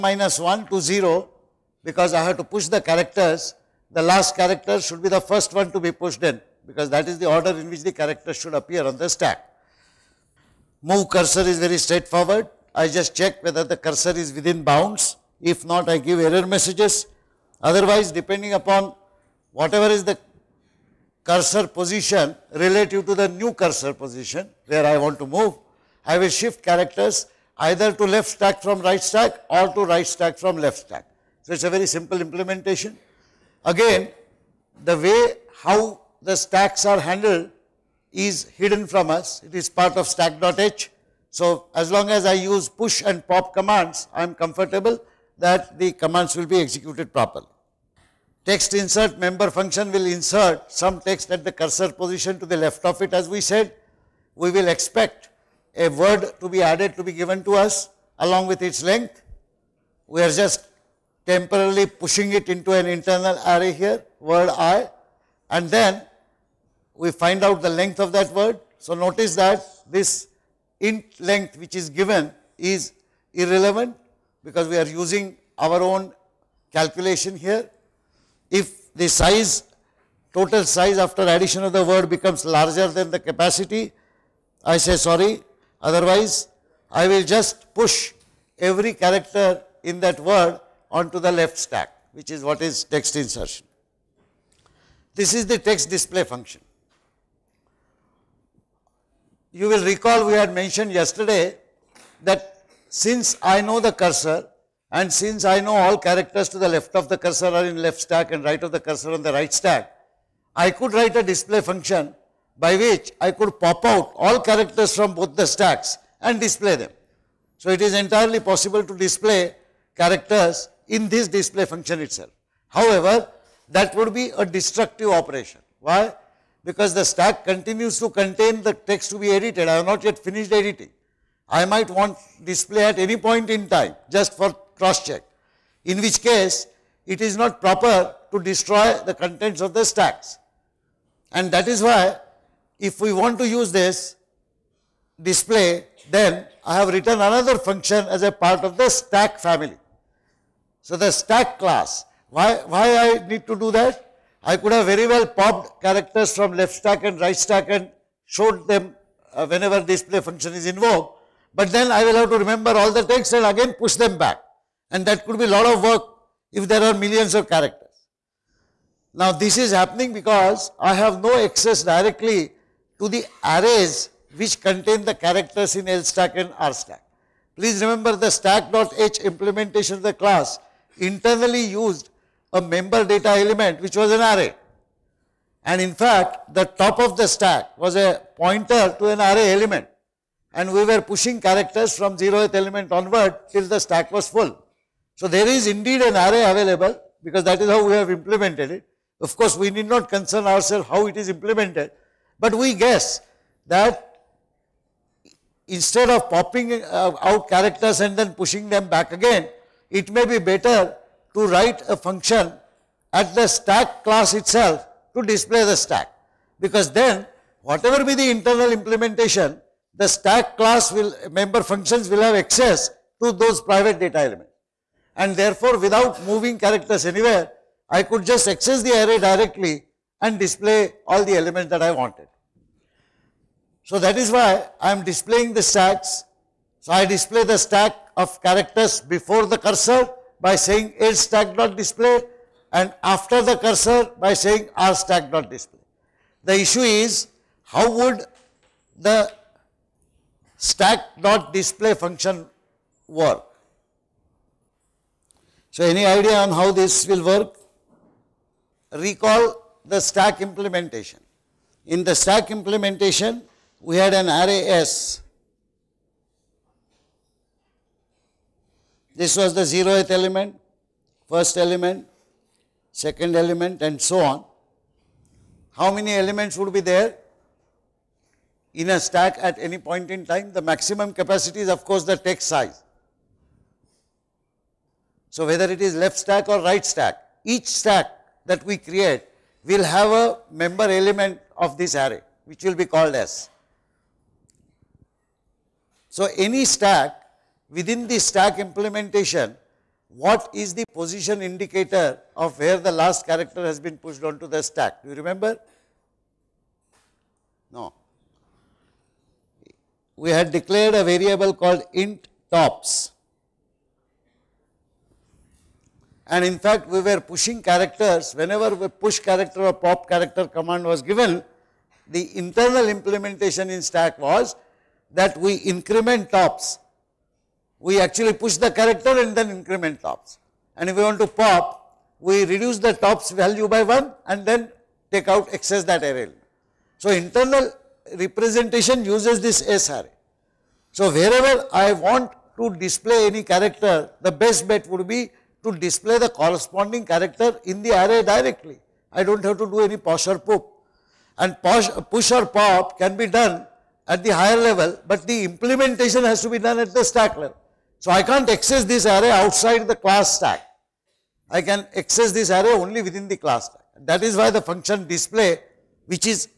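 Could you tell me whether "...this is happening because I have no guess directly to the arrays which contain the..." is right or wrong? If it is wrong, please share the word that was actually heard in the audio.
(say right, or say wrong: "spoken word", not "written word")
wrong: "access", not "guess".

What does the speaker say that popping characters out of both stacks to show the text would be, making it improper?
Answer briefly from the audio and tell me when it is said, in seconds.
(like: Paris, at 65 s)
destructive operation, at 124 s.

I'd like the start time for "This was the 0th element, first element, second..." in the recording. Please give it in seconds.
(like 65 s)
269 s.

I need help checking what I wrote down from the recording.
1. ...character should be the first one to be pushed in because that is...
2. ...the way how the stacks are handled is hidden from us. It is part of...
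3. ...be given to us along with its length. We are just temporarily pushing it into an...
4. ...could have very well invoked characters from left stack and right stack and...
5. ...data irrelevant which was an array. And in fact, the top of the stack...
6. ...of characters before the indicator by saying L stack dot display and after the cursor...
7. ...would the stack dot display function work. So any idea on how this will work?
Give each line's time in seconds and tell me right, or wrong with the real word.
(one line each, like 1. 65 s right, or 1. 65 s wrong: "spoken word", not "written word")
1. 4 s right
2. 34 s right
3. 57 s right
4. 154 s wrong: "popped", not "invoked"
5. 183 s wrong: "element", not "irrelevant"
6. 238 s wrong: "cursor", not "indicator"
7. 247 s right.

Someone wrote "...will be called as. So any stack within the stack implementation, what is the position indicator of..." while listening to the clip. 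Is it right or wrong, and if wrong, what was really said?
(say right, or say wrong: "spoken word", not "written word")
right.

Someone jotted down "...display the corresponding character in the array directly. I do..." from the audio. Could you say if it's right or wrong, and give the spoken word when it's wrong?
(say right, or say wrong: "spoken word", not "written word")
right.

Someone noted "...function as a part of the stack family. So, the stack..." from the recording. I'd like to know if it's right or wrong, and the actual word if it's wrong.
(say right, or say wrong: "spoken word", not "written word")
right.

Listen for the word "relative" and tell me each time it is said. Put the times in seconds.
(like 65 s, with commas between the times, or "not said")
22 s.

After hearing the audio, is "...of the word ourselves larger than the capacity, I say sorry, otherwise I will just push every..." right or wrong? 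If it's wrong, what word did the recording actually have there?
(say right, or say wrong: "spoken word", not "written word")
wrong: "becomes", not "ourselves".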